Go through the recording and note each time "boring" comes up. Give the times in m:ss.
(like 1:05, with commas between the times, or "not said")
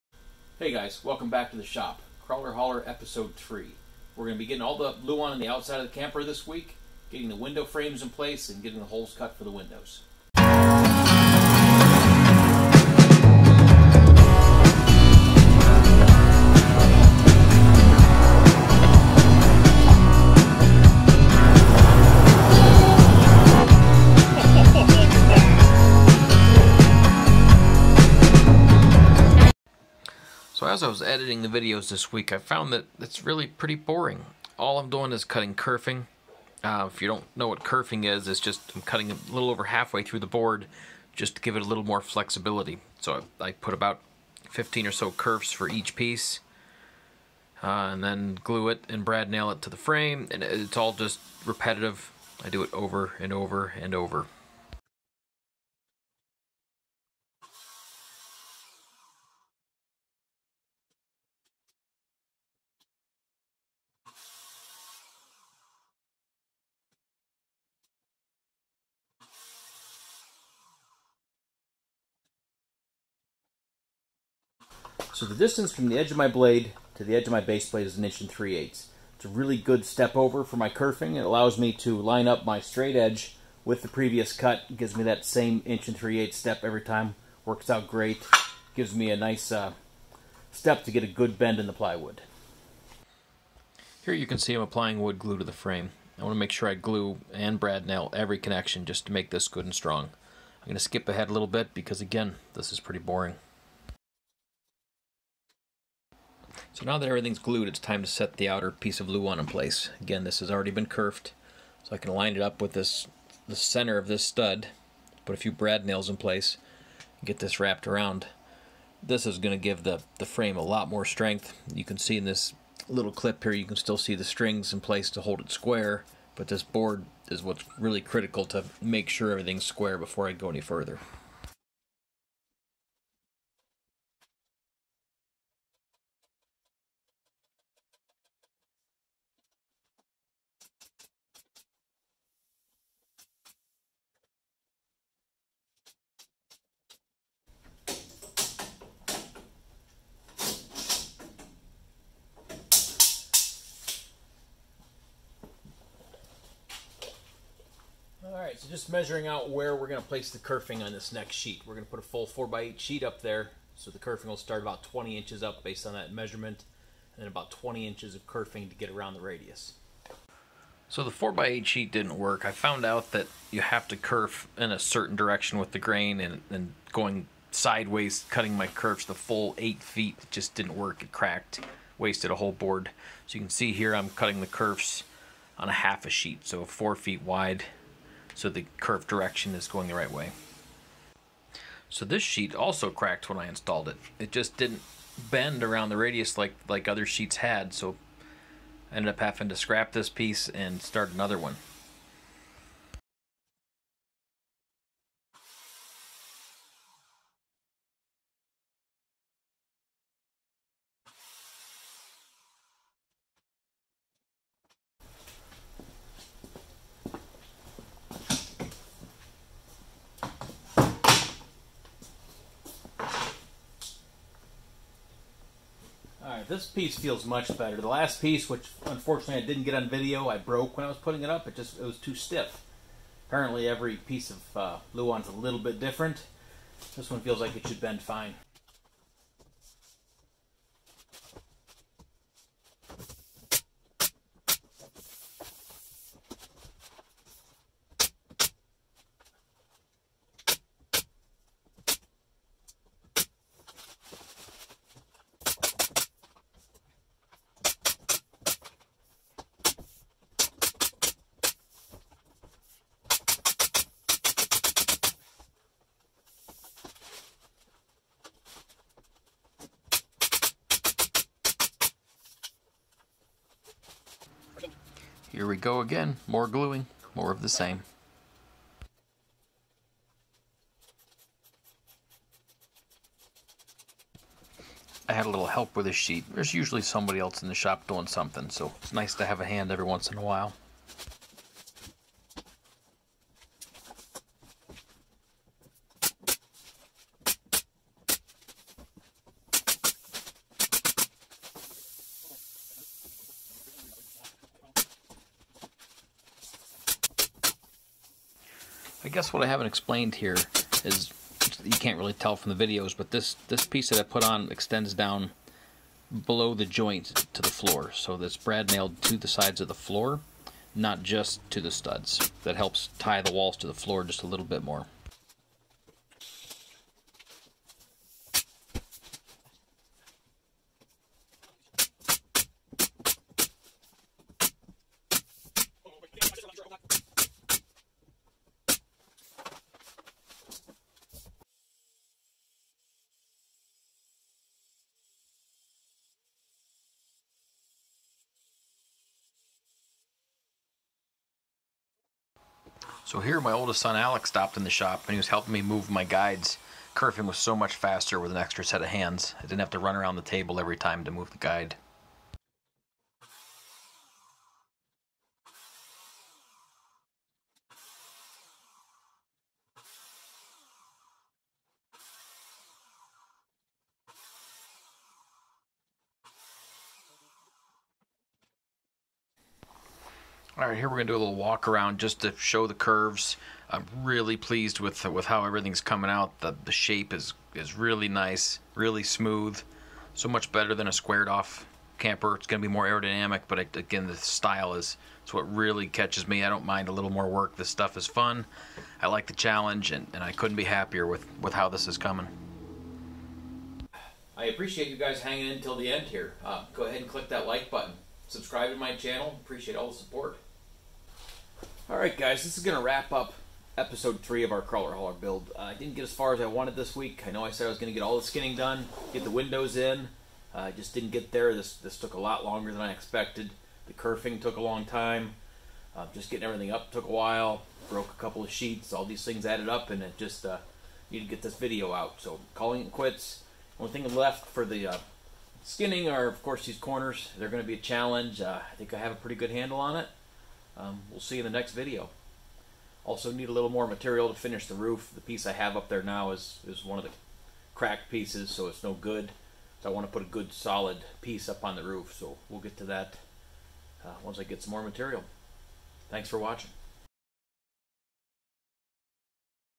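0:33, 1:42.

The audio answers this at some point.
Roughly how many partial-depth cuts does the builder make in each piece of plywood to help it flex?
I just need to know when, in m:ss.
0:44.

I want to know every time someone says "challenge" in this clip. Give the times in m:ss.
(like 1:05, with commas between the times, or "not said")
6:39, 7:17.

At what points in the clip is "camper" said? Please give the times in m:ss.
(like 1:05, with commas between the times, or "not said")
0:05, 6:31.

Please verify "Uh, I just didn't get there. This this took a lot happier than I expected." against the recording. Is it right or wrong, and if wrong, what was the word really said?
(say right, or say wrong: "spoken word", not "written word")
wrong: "longer", not "happier".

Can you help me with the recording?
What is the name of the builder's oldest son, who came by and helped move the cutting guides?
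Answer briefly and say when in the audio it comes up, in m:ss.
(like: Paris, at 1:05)
Alex, at 5:53.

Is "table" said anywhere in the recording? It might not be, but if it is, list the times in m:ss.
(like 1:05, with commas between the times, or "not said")
6:00.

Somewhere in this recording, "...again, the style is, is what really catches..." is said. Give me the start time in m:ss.
6:33.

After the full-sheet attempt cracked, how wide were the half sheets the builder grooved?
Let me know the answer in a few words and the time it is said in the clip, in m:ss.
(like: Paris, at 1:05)
4 feet, at 3:06.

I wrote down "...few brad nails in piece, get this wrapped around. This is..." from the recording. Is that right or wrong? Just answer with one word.
wrong.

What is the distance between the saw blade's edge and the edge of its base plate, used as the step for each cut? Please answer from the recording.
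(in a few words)
1 3/8 inches.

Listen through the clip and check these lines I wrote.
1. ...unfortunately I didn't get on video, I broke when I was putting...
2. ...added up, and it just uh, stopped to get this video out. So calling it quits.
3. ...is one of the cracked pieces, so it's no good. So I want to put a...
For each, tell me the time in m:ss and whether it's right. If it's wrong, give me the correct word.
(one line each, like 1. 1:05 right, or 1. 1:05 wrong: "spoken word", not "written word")
1. 3:48 right
2. 7:09 wrong: "needed", not "stopped"
3. 7:26 right.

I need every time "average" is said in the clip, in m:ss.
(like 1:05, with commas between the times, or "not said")
not said.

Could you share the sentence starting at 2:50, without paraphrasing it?
So the 4x8 sheet didn't work.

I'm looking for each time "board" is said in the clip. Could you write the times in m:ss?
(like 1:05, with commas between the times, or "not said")
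0:40, 2:06, 3:02.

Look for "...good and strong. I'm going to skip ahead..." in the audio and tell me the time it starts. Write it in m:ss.
1:39.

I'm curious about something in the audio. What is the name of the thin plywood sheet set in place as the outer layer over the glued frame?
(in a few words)
Luan.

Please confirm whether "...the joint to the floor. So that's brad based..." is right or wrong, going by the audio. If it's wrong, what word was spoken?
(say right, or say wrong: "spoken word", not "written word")
wrong: "nailed", not "based".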